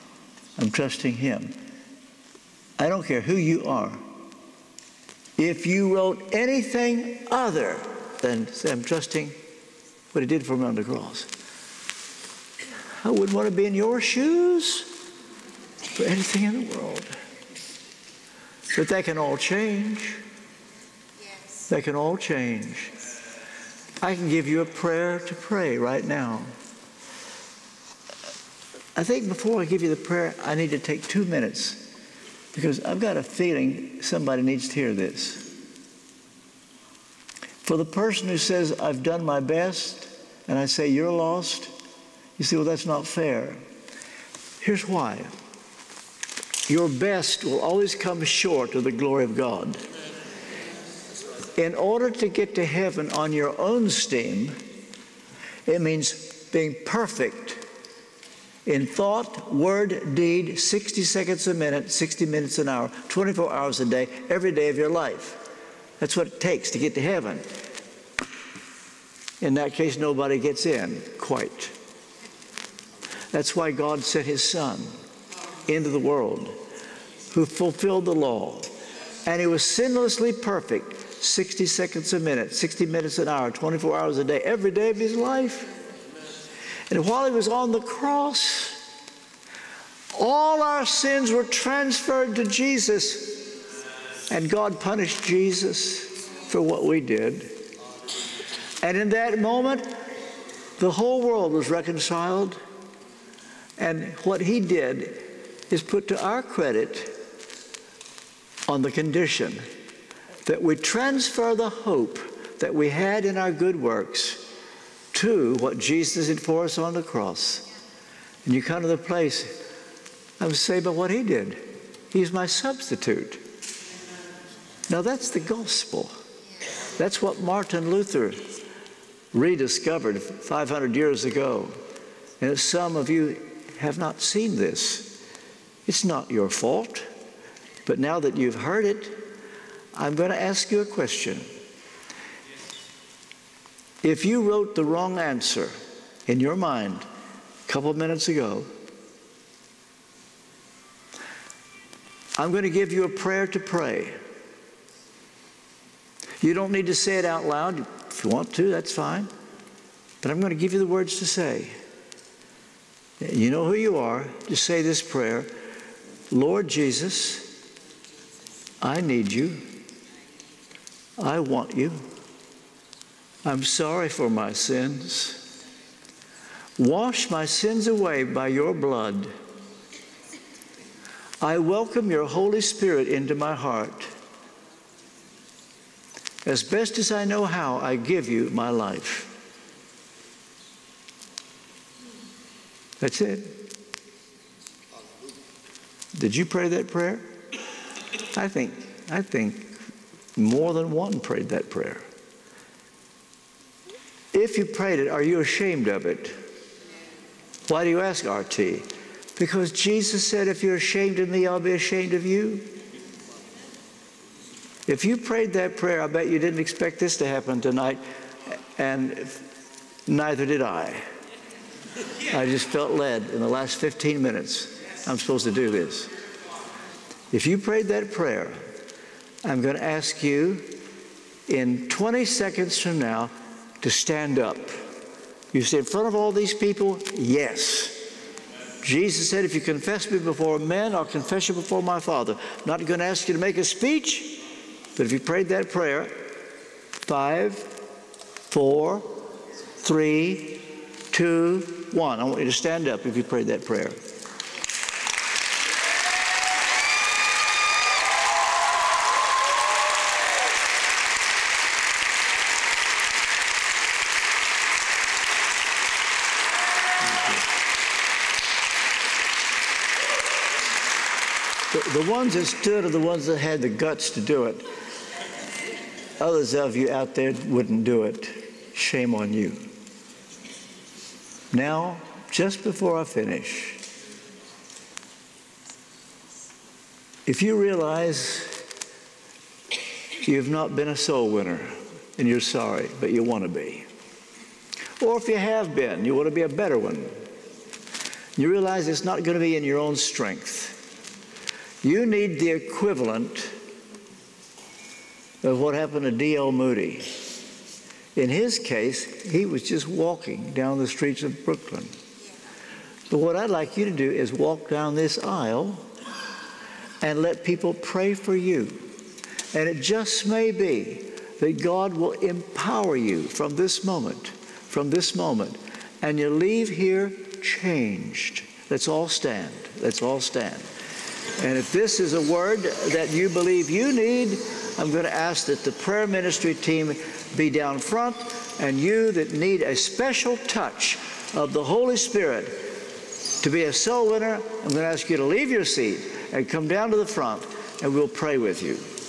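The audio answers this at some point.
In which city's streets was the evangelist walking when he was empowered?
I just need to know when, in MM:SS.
05:11.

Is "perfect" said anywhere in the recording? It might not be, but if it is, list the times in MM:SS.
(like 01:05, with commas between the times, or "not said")
00:56, 01:20.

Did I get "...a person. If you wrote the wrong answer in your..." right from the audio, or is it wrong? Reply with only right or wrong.
wrong.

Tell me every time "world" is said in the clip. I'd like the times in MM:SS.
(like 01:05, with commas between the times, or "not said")
00:16, 01:15, 01:41.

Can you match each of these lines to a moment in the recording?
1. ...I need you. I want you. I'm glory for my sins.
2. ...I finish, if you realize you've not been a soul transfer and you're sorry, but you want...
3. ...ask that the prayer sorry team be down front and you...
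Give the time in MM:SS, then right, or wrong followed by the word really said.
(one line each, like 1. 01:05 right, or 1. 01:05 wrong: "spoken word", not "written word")
1. 02:48 wrong: "sorry", not "glory"
2. 04:42 wrong: "winner", not "transfer"
3. 05:35 wrong: "ministry", not "sorry".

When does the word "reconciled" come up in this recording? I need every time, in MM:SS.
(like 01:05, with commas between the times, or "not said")
01:41.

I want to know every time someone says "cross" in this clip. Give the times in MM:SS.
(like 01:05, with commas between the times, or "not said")
00:10, 01:27, 01:57.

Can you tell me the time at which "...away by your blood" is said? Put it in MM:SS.
02:57.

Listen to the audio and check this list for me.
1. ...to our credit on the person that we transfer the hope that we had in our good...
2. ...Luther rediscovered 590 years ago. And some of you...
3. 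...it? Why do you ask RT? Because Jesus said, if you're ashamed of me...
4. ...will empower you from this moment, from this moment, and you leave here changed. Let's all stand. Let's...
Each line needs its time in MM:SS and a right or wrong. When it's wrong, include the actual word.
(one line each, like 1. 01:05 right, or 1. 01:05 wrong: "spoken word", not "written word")
1. 01:46 wrong: "condition", not "person"
2. 02:07 wrong: "500", not "590"
3. 03:26 right
4. 05:21 right.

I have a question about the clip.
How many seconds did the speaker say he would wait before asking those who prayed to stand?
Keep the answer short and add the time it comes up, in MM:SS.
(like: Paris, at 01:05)
20, at 03:51.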